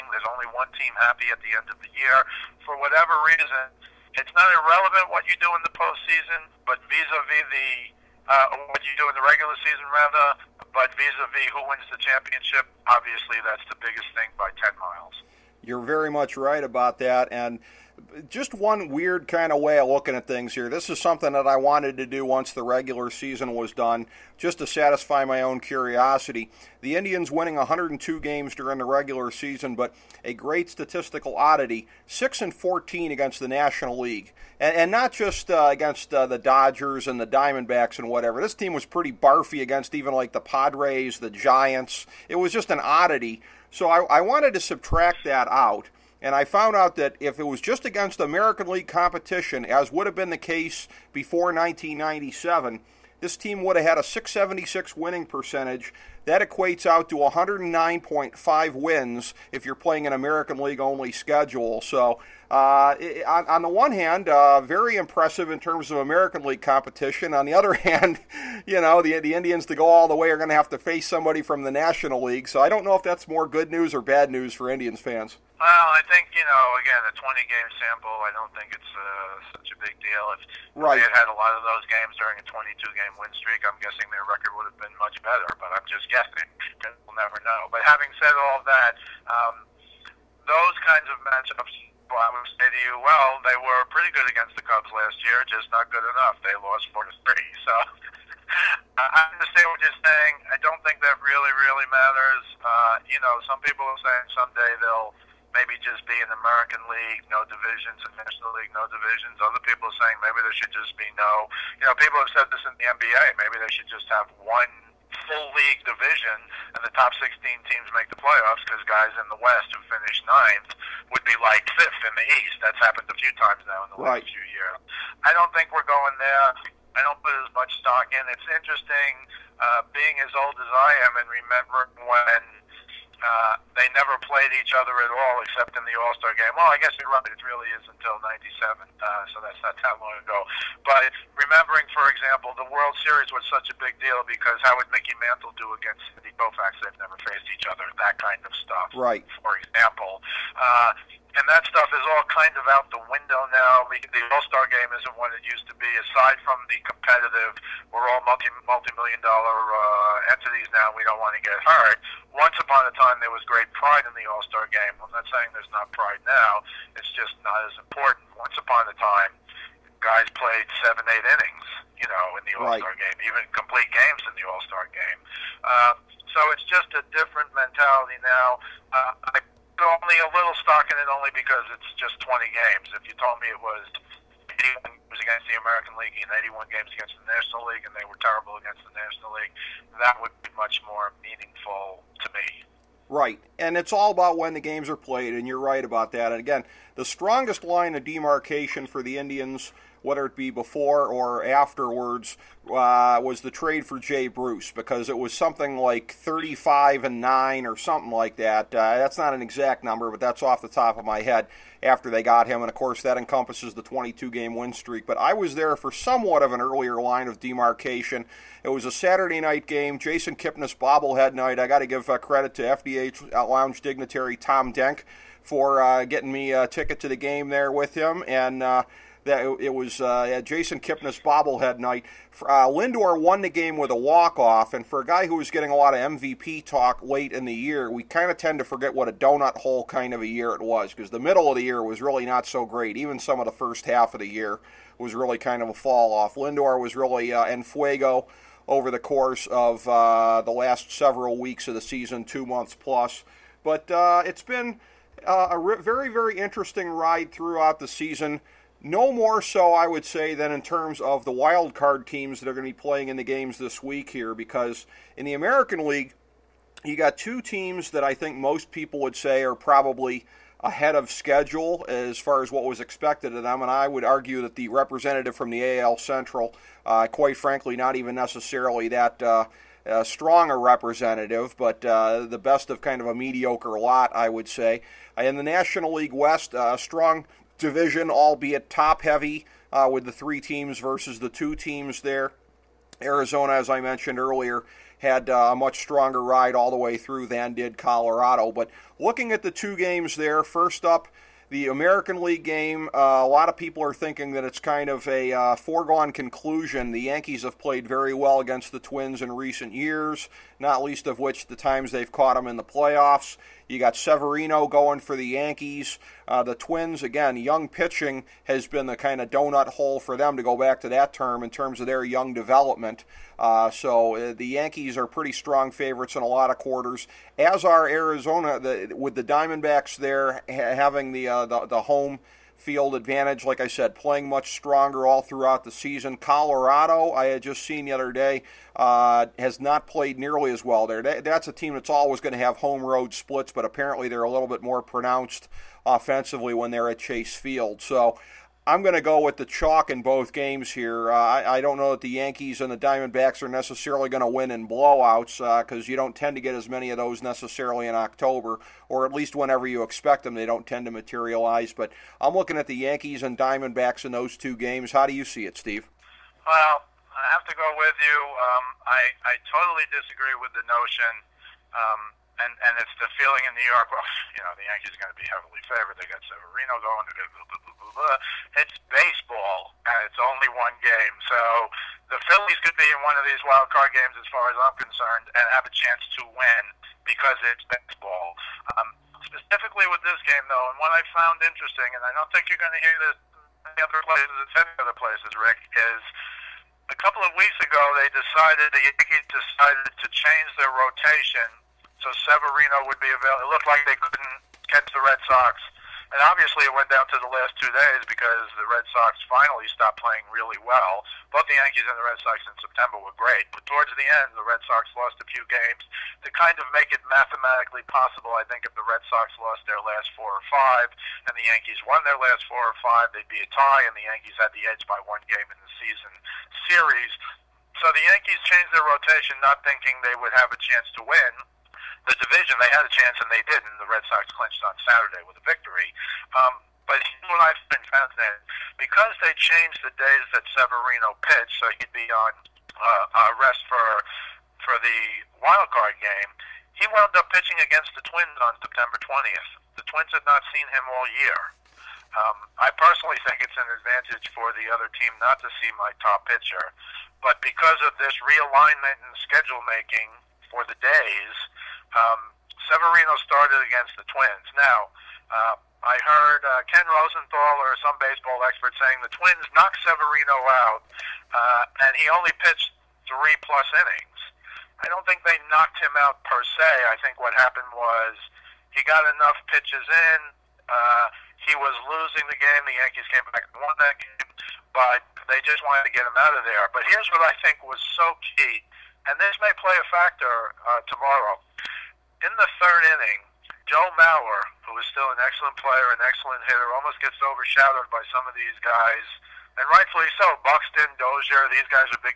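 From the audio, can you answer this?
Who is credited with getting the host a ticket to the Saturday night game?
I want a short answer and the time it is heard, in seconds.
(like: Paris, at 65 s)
Tom Denk, at 224 s.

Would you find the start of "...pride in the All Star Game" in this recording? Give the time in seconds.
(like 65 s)
163 s.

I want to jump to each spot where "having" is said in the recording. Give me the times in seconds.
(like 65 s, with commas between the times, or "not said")
87 s, 330 s.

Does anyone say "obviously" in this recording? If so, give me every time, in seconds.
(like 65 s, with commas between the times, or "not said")
12 s, 406 s.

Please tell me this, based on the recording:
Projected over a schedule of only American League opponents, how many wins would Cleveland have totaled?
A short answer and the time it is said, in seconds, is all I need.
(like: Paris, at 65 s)
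109.5, at 57 s.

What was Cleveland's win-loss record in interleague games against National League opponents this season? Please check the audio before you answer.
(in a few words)
6 and 14.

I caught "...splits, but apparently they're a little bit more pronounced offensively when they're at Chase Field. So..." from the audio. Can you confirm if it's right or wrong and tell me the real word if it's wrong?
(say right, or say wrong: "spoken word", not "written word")
right.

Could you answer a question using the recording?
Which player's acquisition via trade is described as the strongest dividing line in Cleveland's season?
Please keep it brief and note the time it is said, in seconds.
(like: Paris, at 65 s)
Jay Bruce, at 203 s.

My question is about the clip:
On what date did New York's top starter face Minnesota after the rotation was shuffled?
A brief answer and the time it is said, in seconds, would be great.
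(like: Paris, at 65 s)
September 20, at 448 s.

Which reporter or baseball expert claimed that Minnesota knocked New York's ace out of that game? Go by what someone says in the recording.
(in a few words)
Ken Rosenthal.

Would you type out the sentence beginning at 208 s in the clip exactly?
Uh, that's not an exact number, but that's off the top of my head after they got him.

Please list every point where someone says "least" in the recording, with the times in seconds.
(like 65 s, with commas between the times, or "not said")
310 s, 359 s.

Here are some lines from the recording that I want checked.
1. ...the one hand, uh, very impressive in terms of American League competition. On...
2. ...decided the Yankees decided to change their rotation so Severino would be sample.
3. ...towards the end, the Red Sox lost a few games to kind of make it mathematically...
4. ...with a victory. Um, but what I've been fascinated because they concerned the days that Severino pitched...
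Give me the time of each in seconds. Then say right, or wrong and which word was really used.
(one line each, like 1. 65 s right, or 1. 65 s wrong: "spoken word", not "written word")
1. 63 s right
2. 398 s wrong: "available", not "sample"
3. 413 s right
4. 435 s wrong: "changed", not "concerned".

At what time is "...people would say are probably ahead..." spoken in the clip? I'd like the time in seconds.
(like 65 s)
268 s.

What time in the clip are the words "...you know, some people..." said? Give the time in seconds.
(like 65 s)
103 s.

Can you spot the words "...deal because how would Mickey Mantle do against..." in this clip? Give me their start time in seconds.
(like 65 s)
143 s.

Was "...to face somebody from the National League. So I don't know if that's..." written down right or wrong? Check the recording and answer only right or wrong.
right.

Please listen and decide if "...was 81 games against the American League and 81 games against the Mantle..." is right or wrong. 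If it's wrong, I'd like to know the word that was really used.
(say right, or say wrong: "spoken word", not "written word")
wrong: "National", not "Mantle".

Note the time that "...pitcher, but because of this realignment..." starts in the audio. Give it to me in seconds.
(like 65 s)
456 s.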